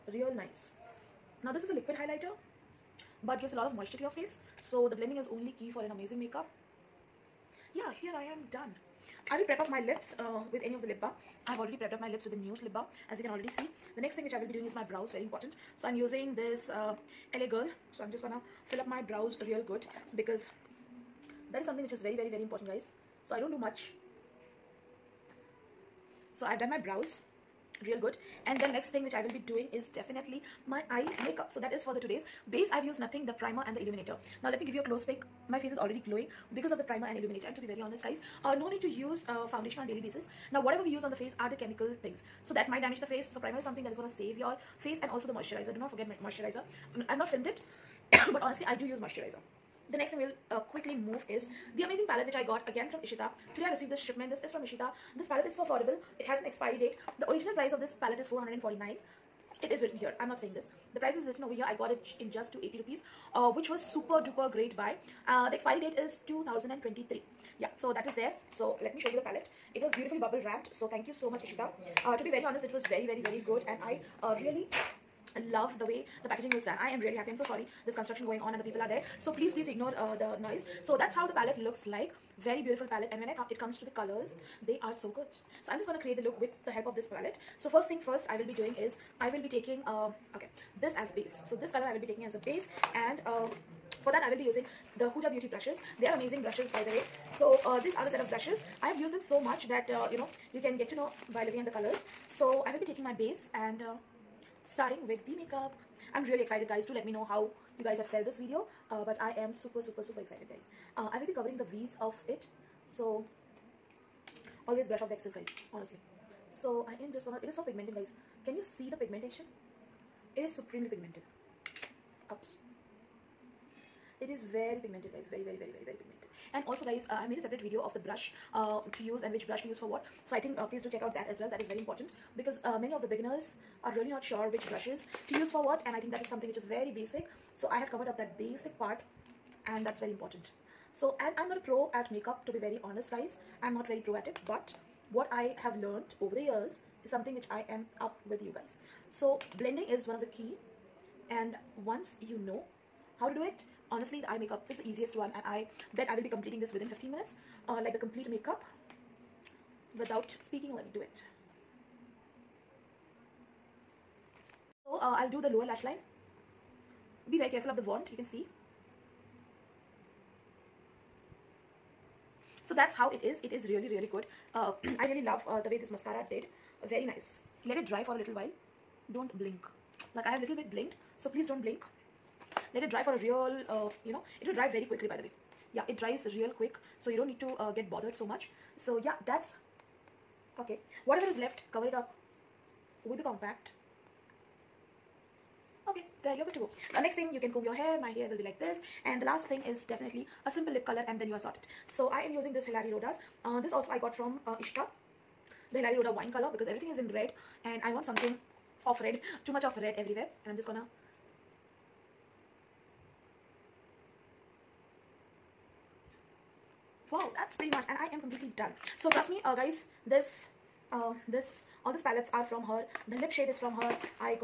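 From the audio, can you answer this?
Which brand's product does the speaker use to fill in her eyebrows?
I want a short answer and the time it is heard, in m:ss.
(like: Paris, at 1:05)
LA Girl, at 0:17.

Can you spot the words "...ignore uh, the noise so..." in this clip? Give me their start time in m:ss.
1:19.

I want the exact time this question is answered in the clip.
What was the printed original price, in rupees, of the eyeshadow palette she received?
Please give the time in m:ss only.
0:58.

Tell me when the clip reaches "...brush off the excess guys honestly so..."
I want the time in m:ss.
1:54.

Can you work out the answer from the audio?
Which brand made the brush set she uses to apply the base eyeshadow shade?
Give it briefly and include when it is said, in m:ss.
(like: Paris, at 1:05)
Huda Beauty, at 1:35.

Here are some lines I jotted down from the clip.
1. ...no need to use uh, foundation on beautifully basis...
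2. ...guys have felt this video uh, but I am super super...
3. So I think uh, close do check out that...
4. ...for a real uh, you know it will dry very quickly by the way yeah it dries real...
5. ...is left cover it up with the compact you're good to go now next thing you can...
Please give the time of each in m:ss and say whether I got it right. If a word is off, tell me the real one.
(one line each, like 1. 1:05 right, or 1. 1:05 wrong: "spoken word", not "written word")
1. 0:38 wrong: "daily", not "beautifully"
2. 1:47 right
3. 2:10 wrong: "please", not "close"
4. 3:03 right
5. 3:11 right.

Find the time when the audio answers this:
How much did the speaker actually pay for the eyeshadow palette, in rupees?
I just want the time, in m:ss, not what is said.
1:02.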